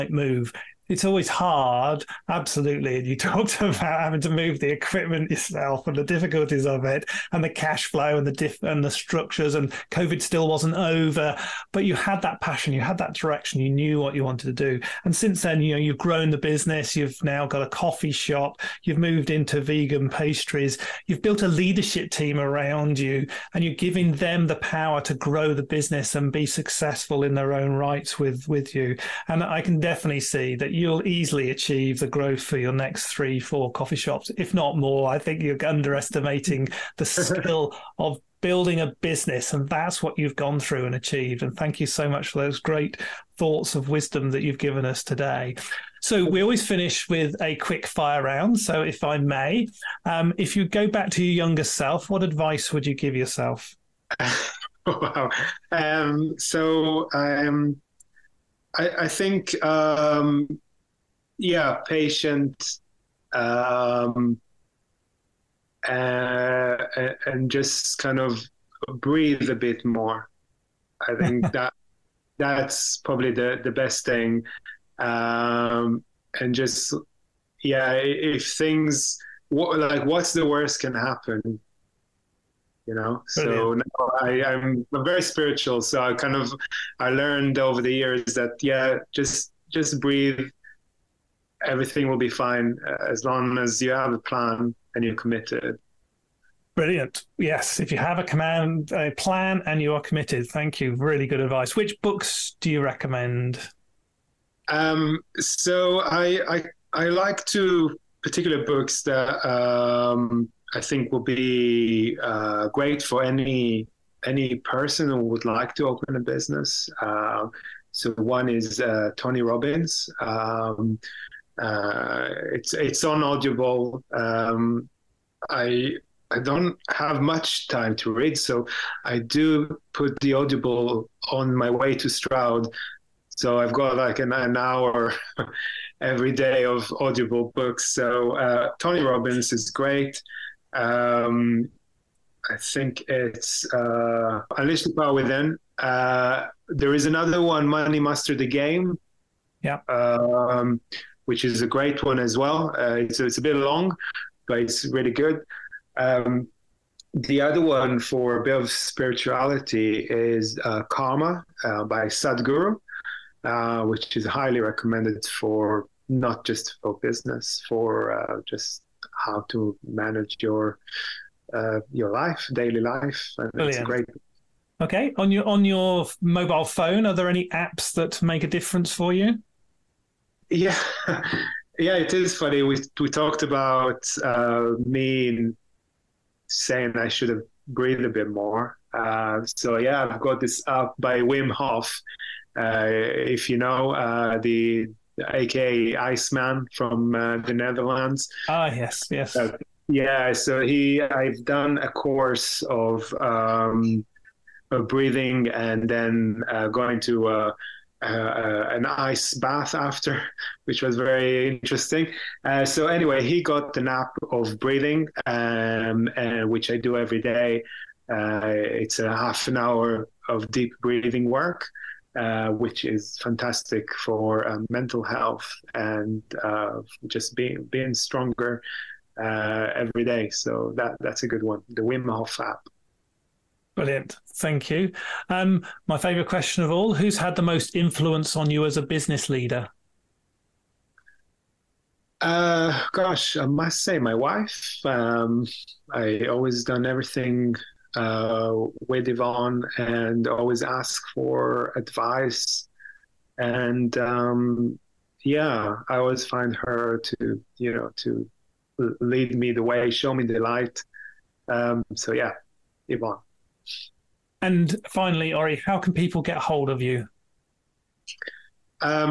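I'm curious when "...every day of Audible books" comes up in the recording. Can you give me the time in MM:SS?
02:16.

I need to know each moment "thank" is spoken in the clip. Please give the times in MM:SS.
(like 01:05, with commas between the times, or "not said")
00:41, 01:40, 03:54.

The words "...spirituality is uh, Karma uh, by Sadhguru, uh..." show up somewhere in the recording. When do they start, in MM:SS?
02:38.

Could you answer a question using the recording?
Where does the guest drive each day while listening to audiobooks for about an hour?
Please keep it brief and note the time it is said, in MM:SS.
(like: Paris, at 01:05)
Stroud, at 02:12.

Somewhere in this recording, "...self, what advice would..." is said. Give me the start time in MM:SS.
00:51.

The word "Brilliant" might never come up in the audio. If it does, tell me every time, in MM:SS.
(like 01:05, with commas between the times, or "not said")
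01:23, 01:36, 02:53, 03:53.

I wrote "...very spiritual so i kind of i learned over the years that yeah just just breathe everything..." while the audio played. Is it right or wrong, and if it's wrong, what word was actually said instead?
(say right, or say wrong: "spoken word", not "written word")
right.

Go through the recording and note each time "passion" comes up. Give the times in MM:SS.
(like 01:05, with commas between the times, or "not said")
00:12.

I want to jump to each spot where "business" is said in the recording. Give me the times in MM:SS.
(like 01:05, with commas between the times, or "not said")
00:16, 00:25, 00:38, 01:56, 02:47, 03:58.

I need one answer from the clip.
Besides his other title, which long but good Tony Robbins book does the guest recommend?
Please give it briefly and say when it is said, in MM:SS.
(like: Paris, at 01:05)
Money Master the Game, at 02:27.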